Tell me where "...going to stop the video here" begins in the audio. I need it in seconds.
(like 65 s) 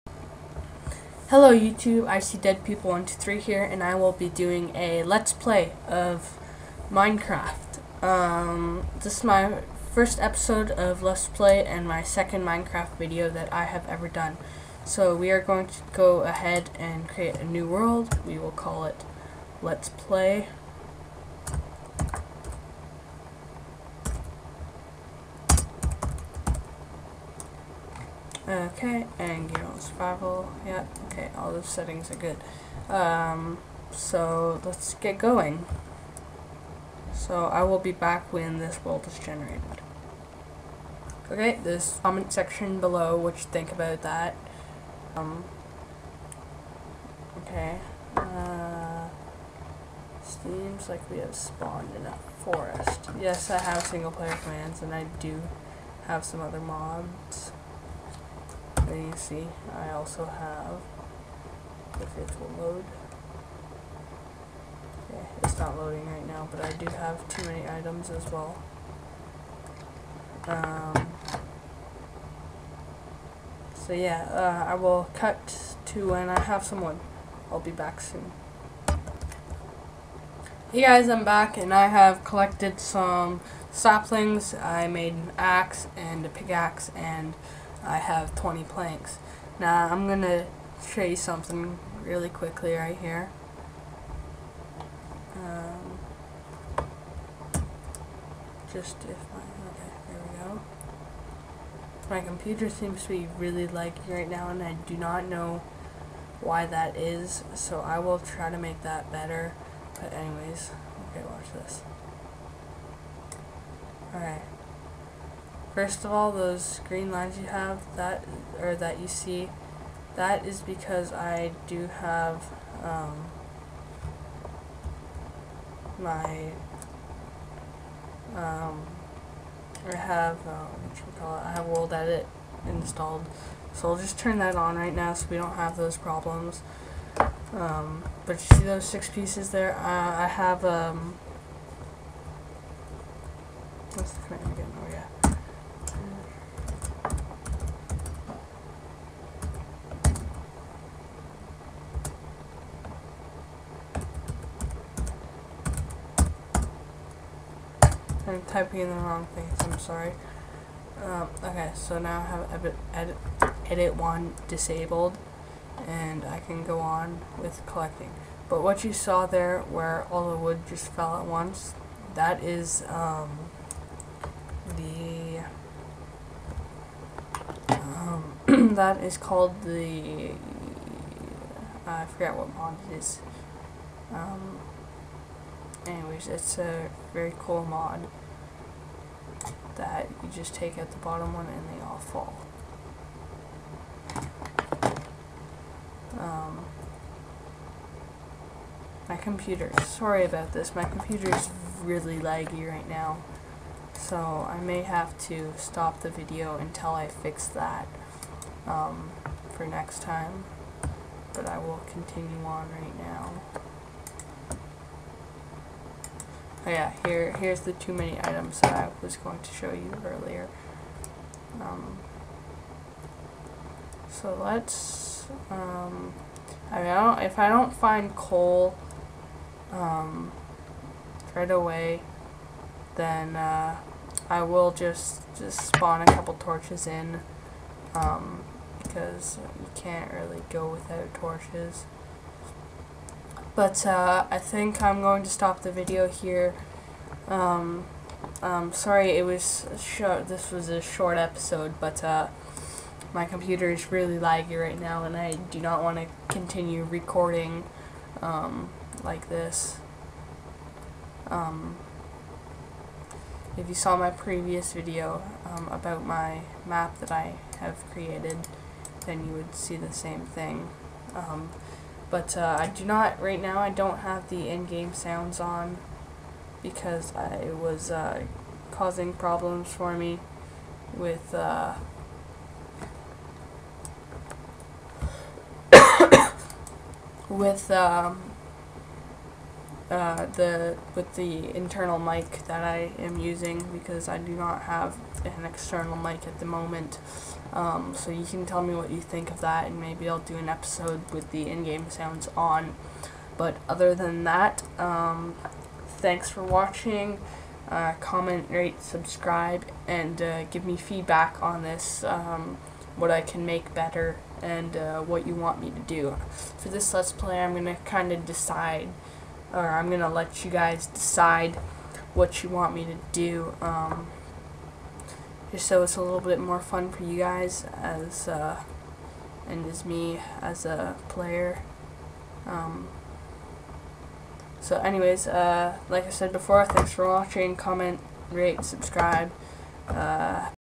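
245 s.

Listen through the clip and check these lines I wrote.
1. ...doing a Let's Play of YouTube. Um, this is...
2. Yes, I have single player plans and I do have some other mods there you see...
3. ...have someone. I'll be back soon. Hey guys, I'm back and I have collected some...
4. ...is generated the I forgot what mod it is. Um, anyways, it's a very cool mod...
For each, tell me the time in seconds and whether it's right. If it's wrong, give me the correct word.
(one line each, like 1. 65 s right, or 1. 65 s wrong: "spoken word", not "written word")
1. 4 s wrong: "Minecraft", not "YouTube"
2. 53 s right
3. 76 s right
4. 179 s wrong: "called", not "generated".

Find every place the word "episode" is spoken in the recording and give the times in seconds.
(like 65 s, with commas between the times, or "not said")
10 s, 251 s, 300 s.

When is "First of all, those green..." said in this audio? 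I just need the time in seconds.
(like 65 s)
115 s.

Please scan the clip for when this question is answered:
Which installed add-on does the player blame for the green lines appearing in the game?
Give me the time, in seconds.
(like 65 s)
131 s.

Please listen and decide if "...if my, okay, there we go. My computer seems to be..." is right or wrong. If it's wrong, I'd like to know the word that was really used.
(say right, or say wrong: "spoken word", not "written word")
right.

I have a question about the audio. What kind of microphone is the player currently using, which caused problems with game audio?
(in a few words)
internal mic.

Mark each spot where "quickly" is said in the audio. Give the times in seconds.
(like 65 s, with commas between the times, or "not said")
92 s.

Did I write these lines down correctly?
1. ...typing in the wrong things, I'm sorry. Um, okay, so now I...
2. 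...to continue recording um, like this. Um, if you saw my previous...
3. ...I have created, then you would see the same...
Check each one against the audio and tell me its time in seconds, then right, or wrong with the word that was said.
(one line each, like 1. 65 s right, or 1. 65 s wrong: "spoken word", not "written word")
1. 158 s right
2. 255 s right
3. 267 s right.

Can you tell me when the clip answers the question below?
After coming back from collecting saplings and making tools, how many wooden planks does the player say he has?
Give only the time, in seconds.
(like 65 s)
88 s.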